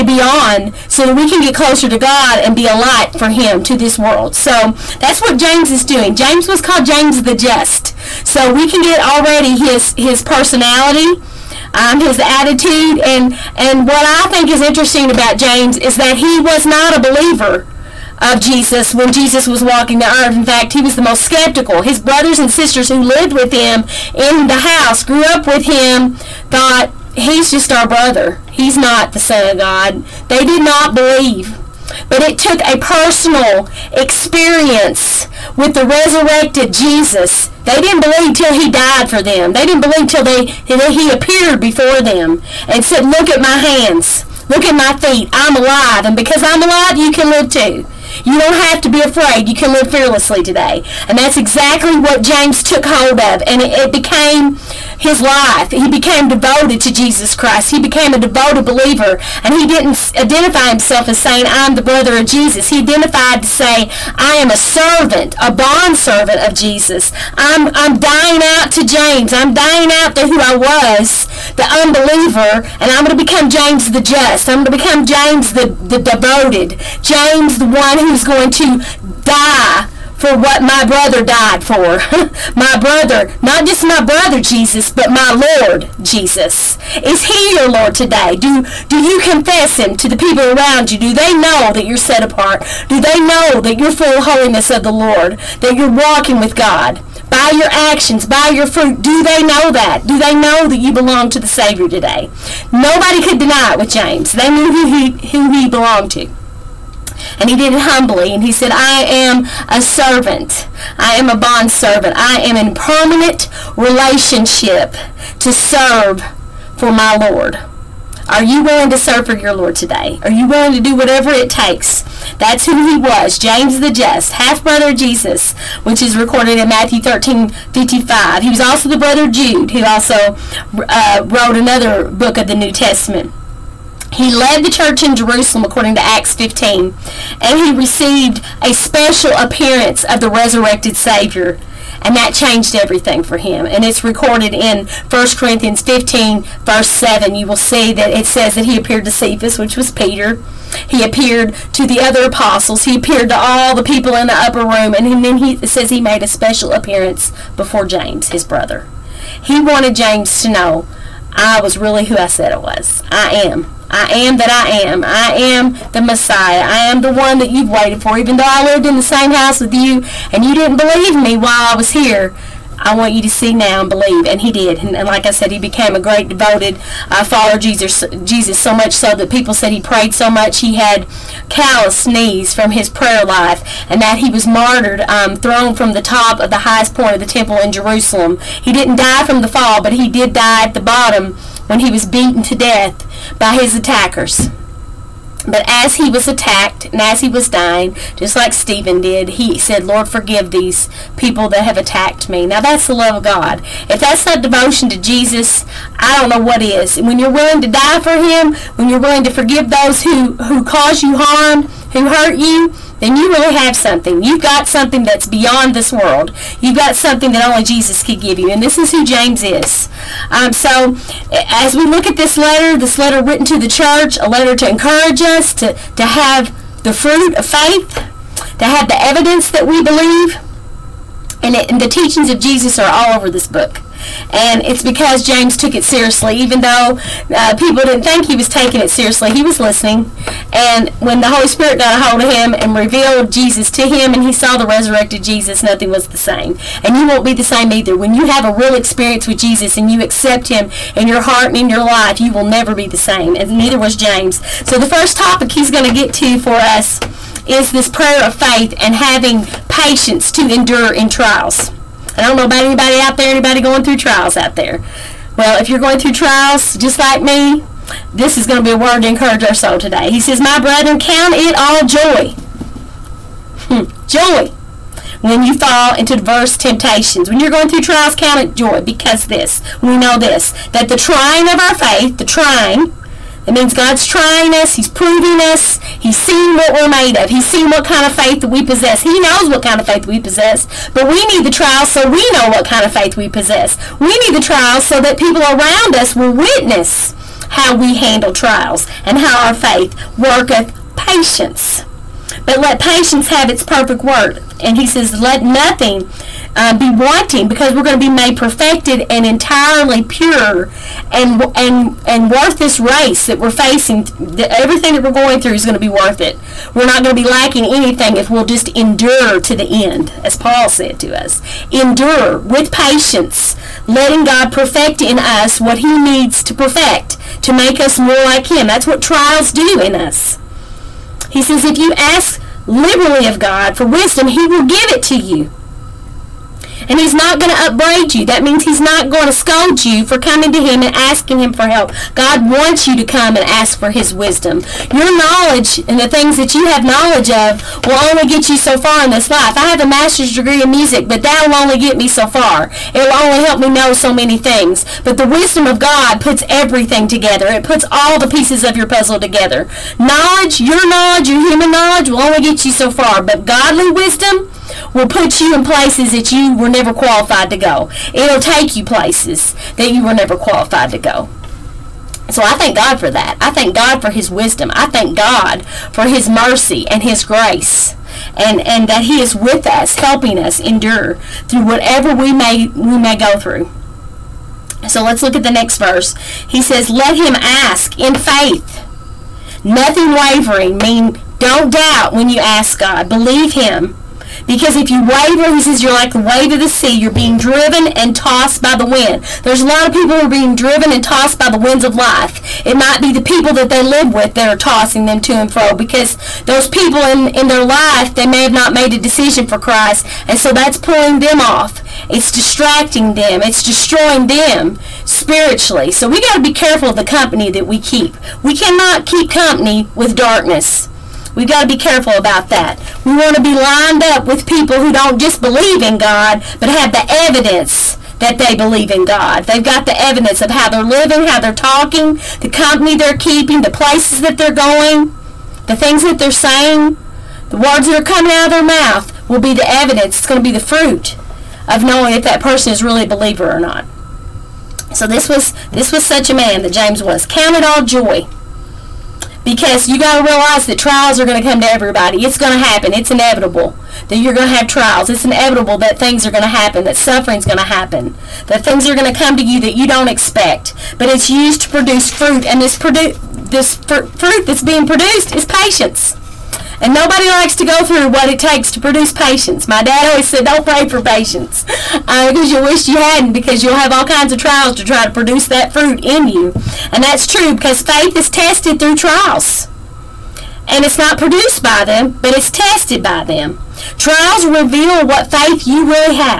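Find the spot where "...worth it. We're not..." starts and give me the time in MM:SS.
05:15.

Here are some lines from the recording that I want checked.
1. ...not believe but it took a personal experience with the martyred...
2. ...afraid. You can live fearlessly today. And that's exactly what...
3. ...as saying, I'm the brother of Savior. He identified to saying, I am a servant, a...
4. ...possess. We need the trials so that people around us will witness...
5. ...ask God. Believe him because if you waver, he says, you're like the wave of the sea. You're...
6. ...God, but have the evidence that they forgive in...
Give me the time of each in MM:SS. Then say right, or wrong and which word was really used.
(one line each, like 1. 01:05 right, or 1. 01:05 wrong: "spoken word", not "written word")
1. 00:30 wrong: "resurrected", not "martyred"
2. 00:49 right
3. 01:01 wrong: "Jesus", not "Savior"
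4. 04:53 right
5. 06:32 right
6. 07:05 wrong: "believe", not "forgive".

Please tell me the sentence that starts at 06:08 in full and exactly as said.
It'll take you places that you were never qualified to go.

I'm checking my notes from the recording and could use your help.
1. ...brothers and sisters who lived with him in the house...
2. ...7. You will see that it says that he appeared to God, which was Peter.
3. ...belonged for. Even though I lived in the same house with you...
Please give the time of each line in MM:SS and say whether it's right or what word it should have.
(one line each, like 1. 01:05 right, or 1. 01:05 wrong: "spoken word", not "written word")
1. 00:22 right
2. 02:26 wrong: "Cephas", not "God"
3. 02:47 wrong: "waited", not "belonged".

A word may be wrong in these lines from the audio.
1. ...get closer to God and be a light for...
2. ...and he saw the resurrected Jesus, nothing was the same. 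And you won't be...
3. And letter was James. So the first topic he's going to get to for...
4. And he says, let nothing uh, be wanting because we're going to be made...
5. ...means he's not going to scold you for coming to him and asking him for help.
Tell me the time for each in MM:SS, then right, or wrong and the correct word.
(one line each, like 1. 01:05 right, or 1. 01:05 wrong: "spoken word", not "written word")
1. 00:01 right
2. 04:04 right
3. 04:13 wrong: "neither", not "letter"
4. 05:04 right
5. 05:38 right.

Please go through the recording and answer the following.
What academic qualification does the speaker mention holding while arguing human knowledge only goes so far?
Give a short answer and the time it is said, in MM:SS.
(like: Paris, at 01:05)
master's degree, at 05:49.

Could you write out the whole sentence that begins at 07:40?
But it's used to produce fruit, and this, produ- this fr fruit that's being produced is patience.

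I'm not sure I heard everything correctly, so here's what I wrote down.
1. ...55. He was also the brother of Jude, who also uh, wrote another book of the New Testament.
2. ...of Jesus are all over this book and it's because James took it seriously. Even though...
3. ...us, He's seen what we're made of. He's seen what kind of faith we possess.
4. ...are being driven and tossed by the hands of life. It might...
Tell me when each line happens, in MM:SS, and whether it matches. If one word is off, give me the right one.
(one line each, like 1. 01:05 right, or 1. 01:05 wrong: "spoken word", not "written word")
1. 02:07 right
2. 03:52 right
3. 04:45 right
4. 06:40 wrong: "winds", not "hands".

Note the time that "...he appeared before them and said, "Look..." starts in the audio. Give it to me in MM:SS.
00:40.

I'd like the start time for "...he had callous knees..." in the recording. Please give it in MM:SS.
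03:00.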